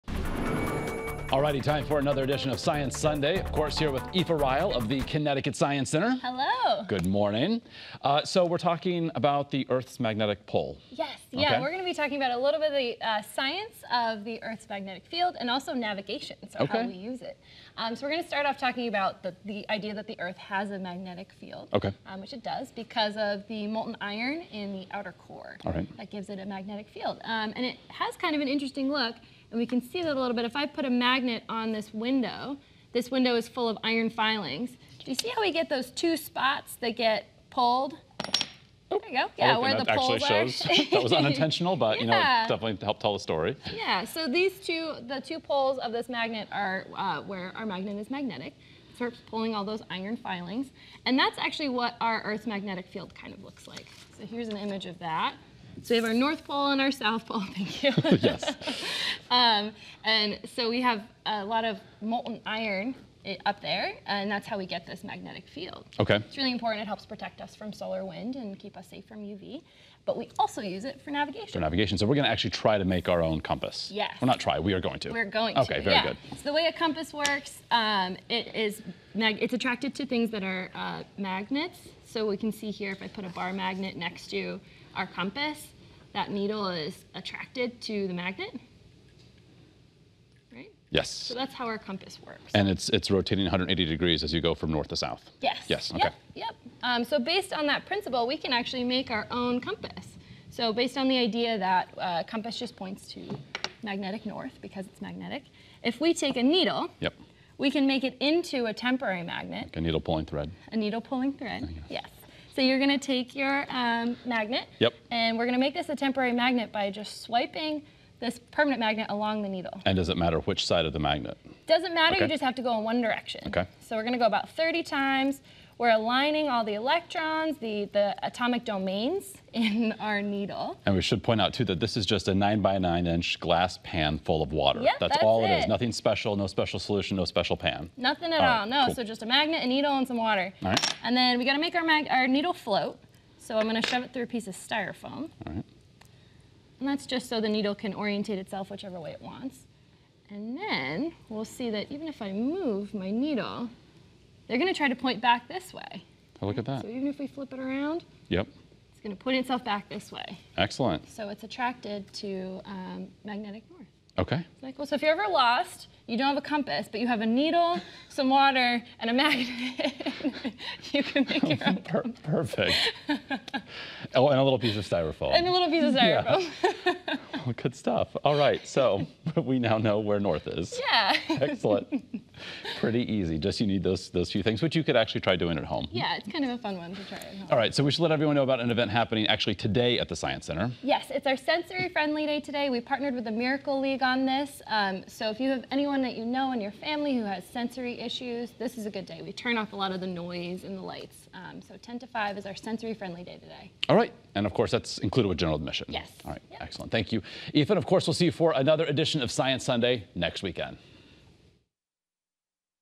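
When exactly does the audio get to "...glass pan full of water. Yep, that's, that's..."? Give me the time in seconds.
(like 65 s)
133 s.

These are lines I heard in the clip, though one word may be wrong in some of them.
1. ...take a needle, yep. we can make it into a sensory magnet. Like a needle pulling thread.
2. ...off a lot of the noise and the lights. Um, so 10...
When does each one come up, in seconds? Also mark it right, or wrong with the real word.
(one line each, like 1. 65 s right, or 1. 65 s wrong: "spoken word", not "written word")
1. 106 s wrong: "temporary", not "sensory"
2. 199 s right.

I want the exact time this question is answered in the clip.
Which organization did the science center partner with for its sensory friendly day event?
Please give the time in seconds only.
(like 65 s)
193 s.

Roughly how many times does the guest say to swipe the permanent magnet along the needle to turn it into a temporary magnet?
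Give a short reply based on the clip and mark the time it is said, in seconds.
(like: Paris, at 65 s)
30, at 124 s.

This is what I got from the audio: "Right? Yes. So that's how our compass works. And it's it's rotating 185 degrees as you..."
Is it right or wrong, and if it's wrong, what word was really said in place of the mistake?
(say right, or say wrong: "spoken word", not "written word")
wrong: "180", not "185".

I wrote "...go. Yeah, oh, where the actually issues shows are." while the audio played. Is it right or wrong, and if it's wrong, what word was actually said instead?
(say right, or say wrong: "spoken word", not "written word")
wrong: "poles", not "issues".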